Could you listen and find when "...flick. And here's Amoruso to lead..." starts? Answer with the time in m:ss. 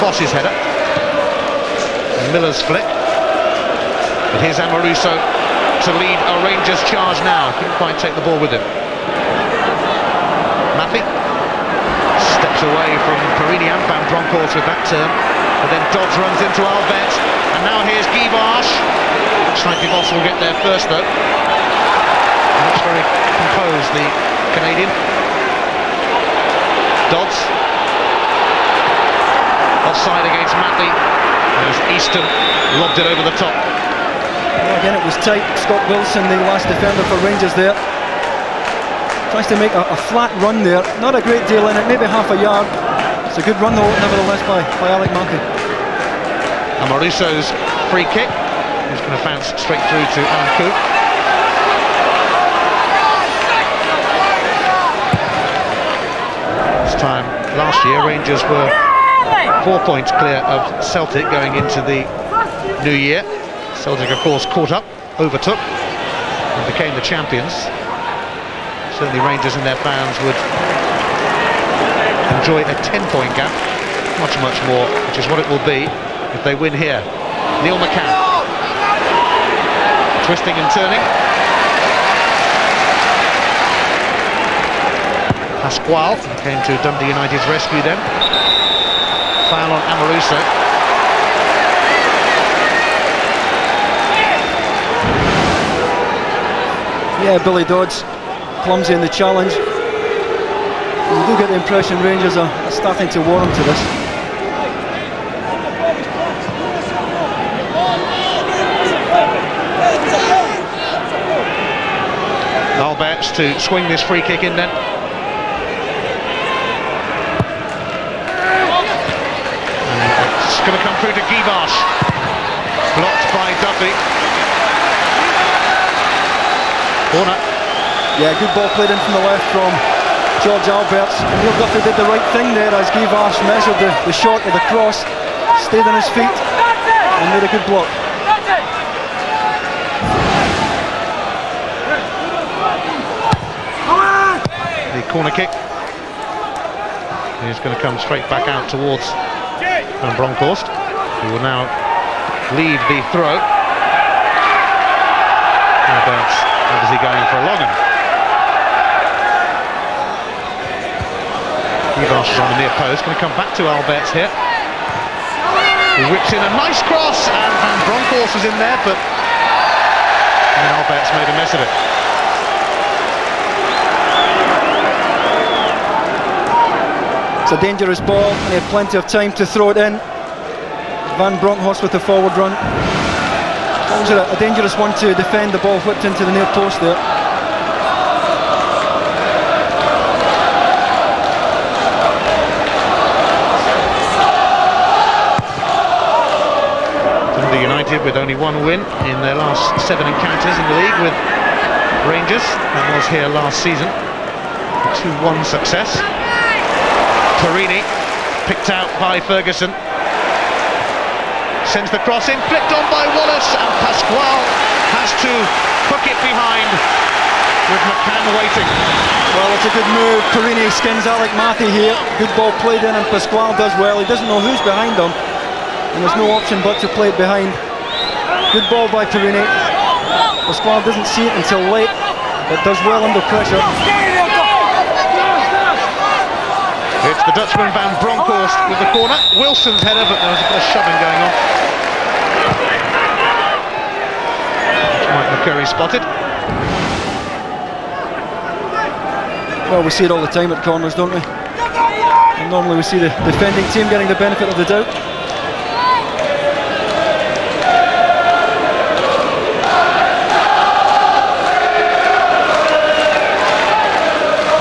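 0:02.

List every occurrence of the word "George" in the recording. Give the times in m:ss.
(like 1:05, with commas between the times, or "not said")
2:10.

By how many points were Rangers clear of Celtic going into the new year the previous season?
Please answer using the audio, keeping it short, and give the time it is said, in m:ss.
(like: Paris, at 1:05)
4, at 0:59.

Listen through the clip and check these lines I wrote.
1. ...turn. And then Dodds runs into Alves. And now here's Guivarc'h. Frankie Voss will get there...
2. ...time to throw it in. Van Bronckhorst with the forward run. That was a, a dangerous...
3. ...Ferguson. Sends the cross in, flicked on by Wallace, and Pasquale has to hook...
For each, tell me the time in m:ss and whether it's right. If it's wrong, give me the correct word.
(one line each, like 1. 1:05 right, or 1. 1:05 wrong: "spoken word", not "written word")
1. 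0:14 right
2. 2:59 right
3. 3:29 right.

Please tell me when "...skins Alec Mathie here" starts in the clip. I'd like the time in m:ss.
3:40.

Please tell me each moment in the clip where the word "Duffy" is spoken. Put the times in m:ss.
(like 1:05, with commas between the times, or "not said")
2:03, 2:11.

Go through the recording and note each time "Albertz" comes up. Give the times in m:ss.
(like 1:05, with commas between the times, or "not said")
2:10, 2:43, 2:50.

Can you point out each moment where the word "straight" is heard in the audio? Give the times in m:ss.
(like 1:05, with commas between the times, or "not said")
0:49, 2:28.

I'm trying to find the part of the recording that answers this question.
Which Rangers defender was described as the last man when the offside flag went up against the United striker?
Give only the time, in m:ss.
0:35.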